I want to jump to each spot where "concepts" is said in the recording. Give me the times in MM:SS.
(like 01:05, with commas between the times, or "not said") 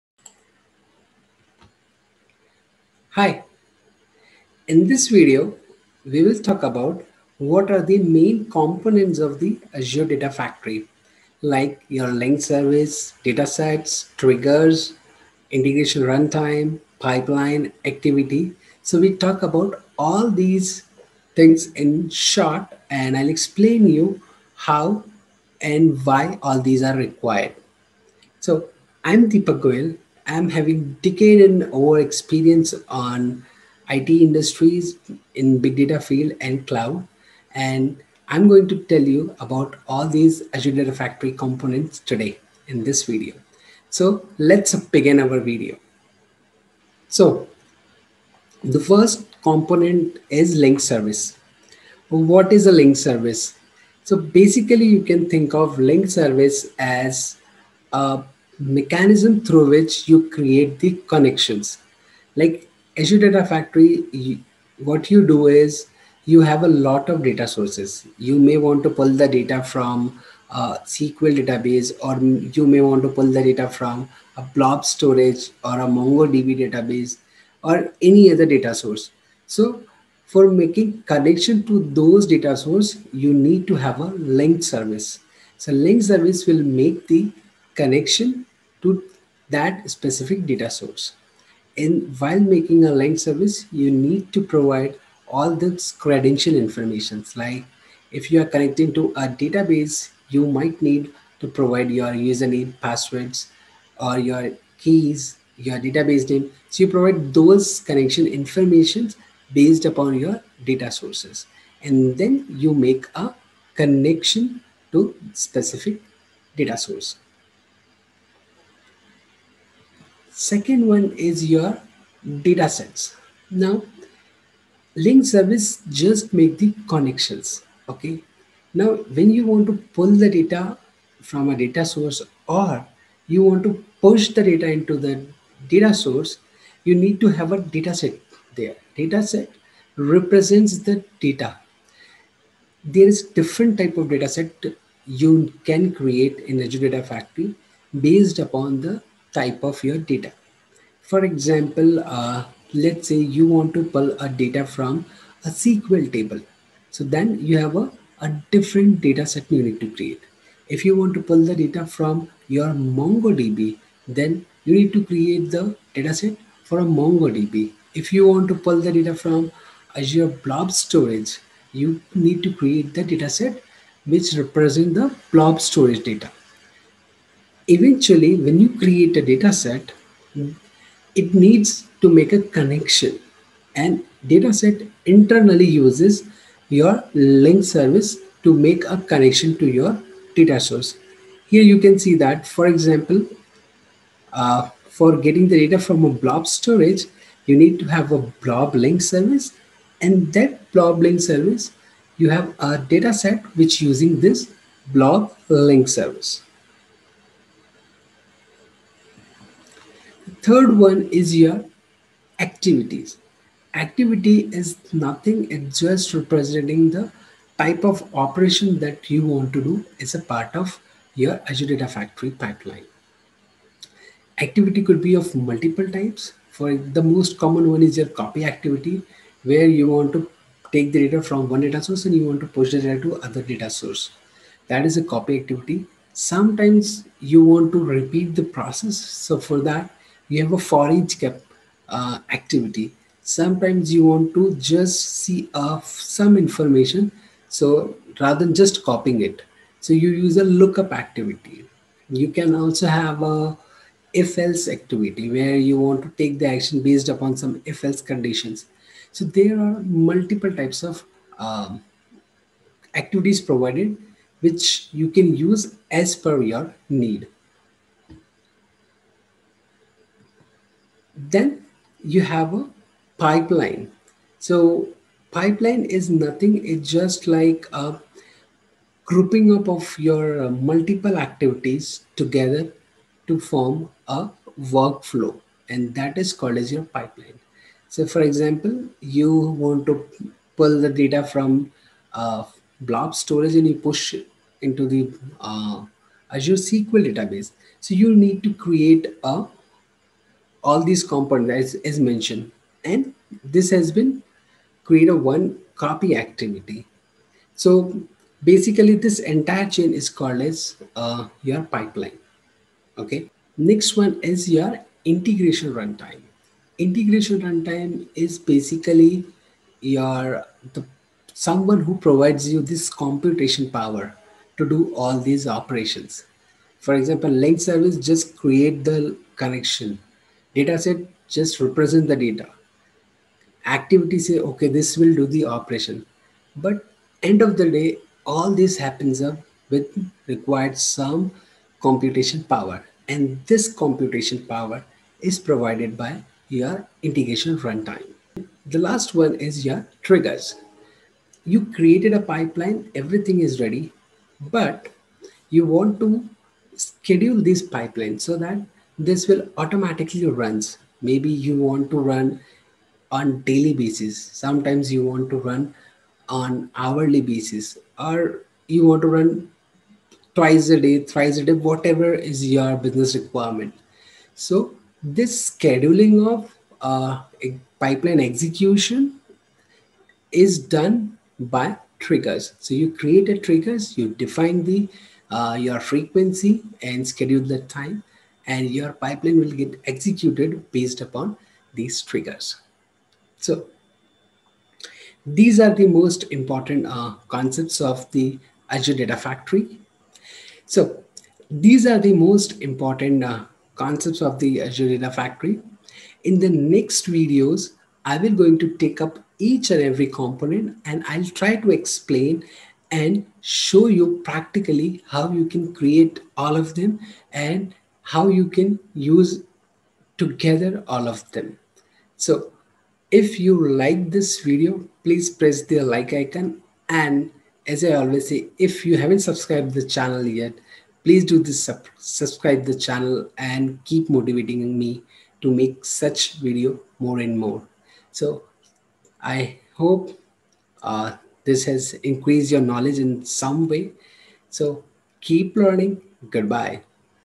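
06:37, 06:43.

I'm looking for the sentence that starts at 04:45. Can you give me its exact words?
And that is called as your pipeline.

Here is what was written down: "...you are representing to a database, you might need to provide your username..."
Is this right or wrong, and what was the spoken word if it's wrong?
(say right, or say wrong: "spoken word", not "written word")
wrong: "connecting", not "representing".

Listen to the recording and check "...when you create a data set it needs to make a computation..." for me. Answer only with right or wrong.
wrong.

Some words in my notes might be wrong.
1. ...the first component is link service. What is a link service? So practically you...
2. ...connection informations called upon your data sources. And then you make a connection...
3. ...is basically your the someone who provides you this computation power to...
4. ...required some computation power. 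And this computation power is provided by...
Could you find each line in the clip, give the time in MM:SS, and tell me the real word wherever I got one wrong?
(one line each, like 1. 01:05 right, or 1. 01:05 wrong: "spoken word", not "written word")
1. 00:48 wrong: "basically", not "practically"
2. 01:47 wrong: "based", not "called"
3. 05:18 right
4. 05:40 right.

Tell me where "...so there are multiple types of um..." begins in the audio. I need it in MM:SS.
04:19.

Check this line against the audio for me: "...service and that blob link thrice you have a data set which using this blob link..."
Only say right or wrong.
wrong.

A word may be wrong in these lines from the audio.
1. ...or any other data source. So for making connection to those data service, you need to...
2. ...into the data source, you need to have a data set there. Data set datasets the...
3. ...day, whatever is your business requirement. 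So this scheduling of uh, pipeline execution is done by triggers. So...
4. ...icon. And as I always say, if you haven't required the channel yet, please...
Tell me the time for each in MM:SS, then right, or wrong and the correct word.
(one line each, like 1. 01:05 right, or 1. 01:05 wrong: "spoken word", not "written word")
1. 01:17 wrong: "source", not "service"
2. 02:14 wrong: "represents", not "datasets"
3. 06:11 right
4. 07:06 wrong: "subscribed", not "required".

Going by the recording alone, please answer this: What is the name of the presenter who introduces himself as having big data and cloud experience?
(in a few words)
Deepak Goyal.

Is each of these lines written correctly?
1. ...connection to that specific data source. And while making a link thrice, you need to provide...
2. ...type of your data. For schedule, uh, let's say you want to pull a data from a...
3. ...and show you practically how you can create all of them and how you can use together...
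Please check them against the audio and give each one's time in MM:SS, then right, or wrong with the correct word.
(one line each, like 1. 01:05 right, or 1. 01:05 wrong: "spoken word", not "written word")
1. 01:27 wrong: "service", not "thrice"
2. 02:29 wrong: "example", not "schedule"
3. 06:52 right.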